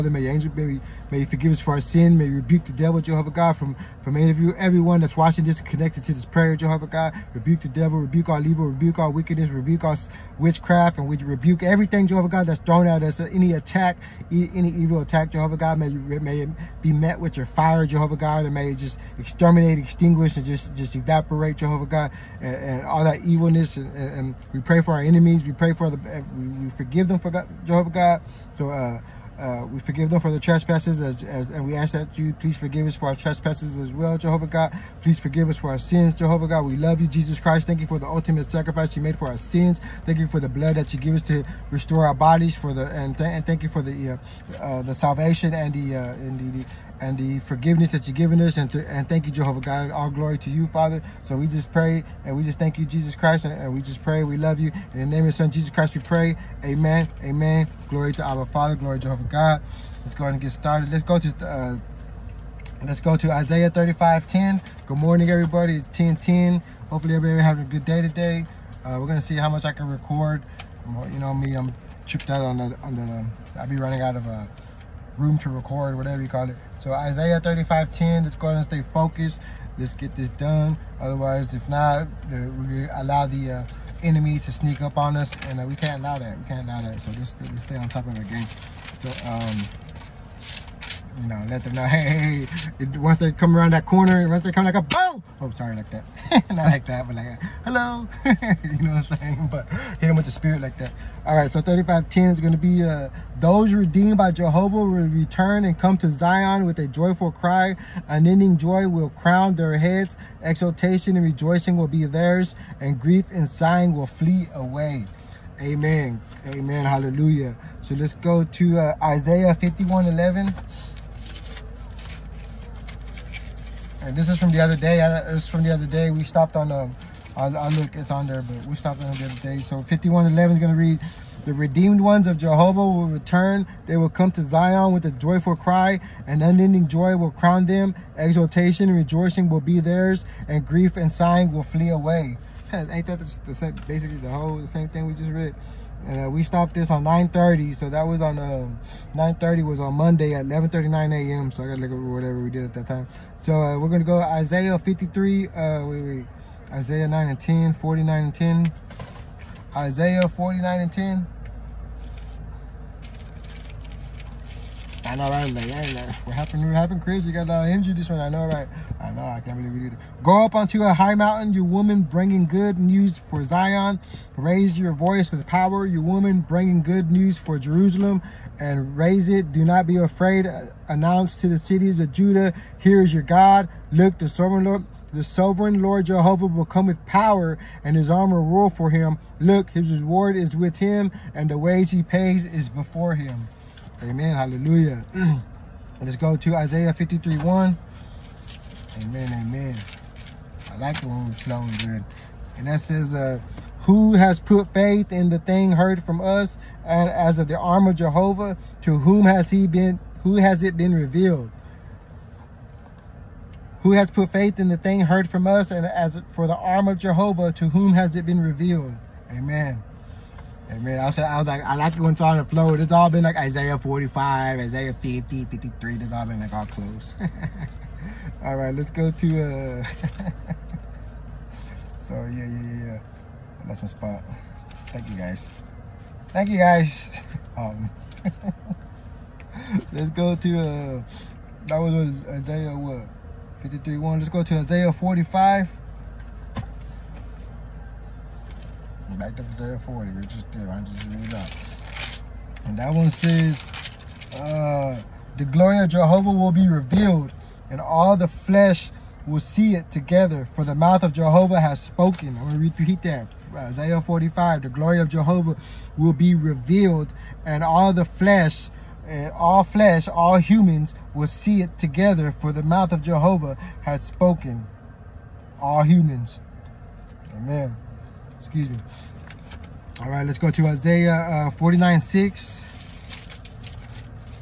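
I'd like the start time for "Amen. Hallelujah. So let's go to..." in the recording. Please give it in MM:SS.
01:56.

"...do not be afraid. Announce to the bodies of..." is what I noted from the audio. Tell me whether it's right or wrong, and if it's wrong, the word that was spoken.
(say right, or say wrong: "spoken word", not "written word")
wrong: "cities", not "bodies".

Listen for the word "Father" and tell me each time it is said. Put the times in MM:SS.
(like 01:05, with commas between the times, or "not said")
00:50, 00:58.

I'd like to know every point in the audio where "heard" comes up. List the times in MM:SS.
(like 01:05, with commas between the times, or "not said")
03:25, 03:34.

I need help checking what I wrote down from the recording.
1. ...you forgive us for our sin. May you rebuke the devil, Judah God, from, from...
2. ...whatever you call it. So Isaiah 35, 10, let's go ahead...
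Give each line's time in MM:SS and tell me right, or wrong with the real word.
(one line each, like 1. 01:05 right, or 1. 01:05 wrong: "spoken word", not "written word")
1. 00:01 wrong: "Jehovah", not "Judah"
2. 01:15 right.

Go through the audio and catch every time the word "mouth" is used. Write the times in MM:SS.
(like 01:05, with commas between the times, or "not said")
04:20, 04:32.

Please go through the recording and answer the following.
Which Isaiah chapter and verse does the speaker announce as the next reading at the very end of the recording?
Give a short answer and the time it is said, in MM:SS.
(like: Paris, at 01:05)
Isaiah 49:6, at 04:40.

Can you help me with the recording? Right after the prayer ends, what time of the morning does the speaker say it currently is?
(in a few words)
10:10.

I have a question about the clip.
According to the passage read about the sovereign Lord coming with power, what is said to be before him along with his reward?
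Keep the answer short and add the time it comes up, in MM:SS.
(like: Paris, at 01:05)
the wage he pays, at 03:11.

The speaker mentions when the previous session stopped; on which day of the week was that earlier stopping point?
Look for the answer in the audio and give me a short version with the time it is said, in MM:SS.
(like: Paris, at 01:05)
Monday, at 02:29.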